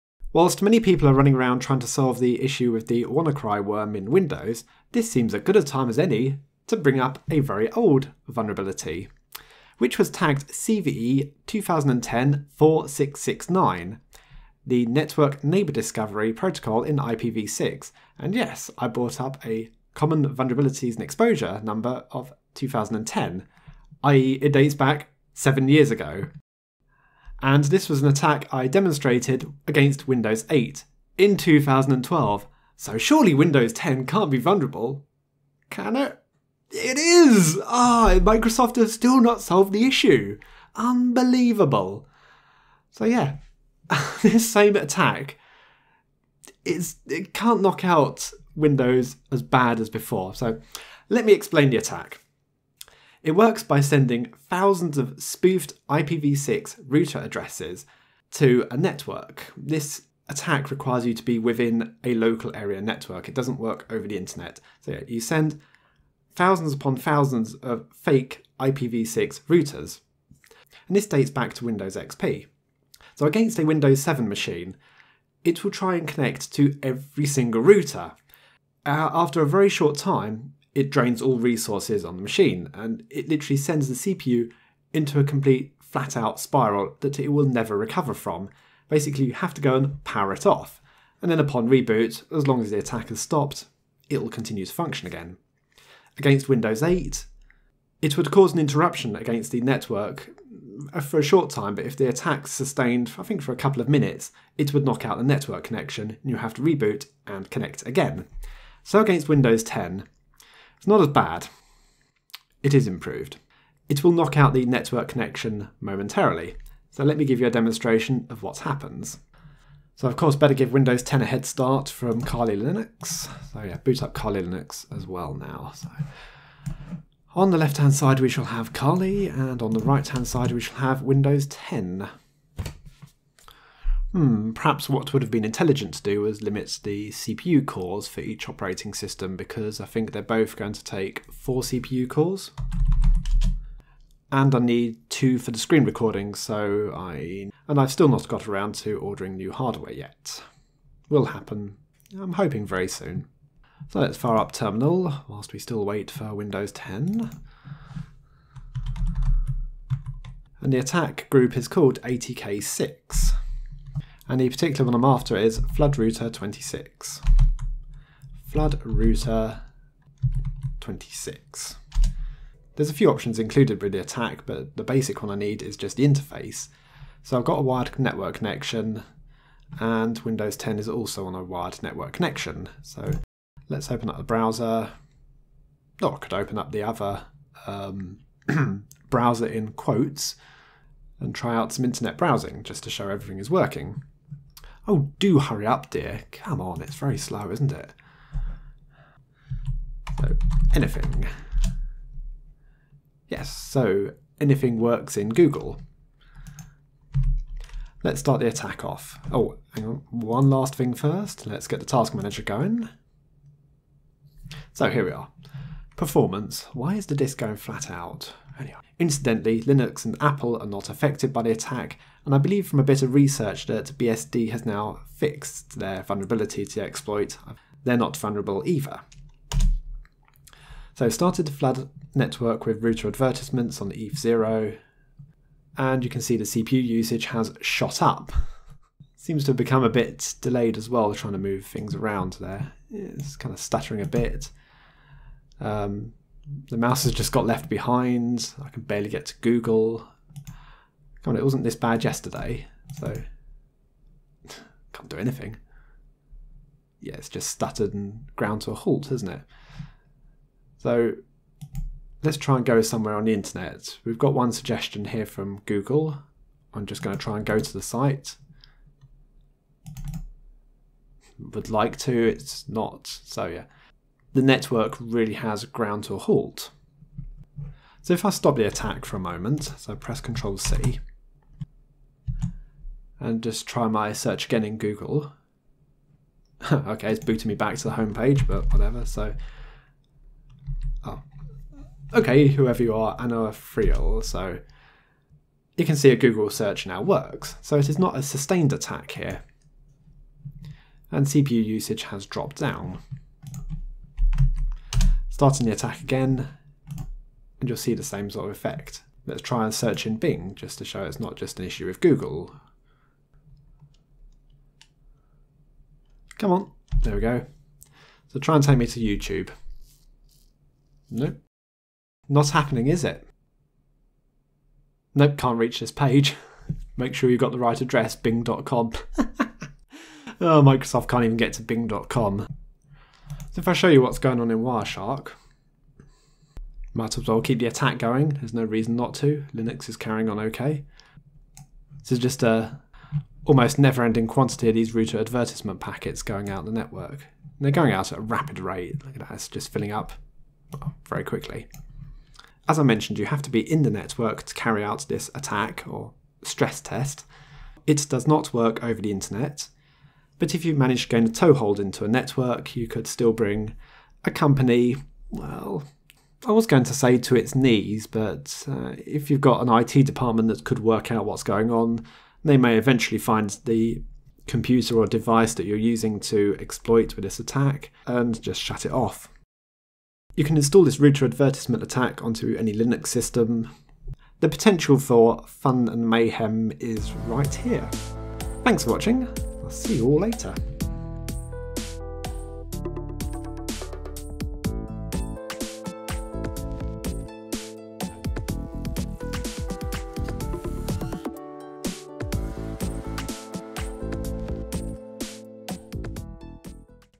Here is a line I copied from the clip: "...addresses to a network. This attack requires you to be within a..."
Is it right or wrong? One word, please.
right.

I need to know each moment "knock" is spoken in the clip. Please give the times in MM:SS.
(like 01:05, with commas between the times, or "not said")
00:47, 01:44, 01:54.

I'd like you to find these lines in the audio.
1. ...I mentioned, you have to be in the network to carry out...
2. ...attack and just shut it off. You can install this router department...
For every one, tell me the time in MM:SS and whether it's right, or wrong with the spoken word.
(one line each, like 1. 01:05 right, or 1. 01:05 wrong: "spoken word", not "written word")
1. 05:52 right
2. 06:17 wrong: "advertisement", not "department".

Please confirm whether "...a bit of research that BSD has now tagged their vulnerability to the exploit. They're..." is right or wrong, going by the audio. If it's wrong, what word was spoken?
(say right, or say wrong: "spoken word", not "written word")
wrong: "fixed", not "tagged".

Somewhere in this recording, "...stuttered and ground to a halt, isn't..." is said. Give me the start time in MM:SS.
04:17.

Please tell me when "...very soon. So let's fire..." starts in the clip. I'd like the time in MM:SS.
02:32.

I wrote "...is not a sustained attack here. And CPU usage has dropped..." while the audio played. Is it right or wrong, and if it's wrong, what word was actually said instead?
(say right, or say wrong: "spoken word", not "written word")
right.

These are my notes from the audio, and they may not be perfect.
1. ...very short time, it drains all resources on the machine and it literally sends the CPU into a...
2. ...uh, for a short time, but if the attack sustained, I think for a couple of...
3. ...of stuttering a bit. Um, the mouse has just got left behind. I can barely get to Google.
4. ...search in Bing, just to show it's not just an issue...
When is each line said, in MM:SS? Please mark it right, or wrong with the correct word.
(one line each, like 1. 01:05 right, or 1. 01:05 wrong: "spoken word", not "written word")
1. 01:19 right
2. 01:40 right
3. 04:03 right
4. 05:09 right.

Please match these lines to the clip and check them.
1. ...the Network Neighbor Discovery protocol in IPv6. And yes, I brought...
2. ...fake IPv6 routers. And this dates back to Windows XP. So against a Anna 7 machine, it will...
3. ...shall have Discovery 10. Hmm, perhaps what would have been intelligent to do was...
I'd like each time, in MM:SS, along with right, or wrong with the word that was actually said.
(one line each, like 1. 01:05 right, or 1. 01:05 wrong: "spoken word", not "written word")
1. 00:14 right
2. 01:07 wrong: "Windows", not "Anna"
3. 02:10 wrong: "Windows", not "Discovery".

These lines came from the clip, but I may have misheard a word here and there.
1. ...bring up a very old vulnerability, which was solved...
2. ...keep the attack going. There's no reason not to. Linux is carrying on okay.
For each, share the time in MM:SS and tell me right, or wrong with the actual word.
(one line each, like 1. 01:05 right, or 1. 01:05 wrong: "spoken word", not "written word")
1. 00:06 wrong: "tagged", not "solved"
2. 05:37 right.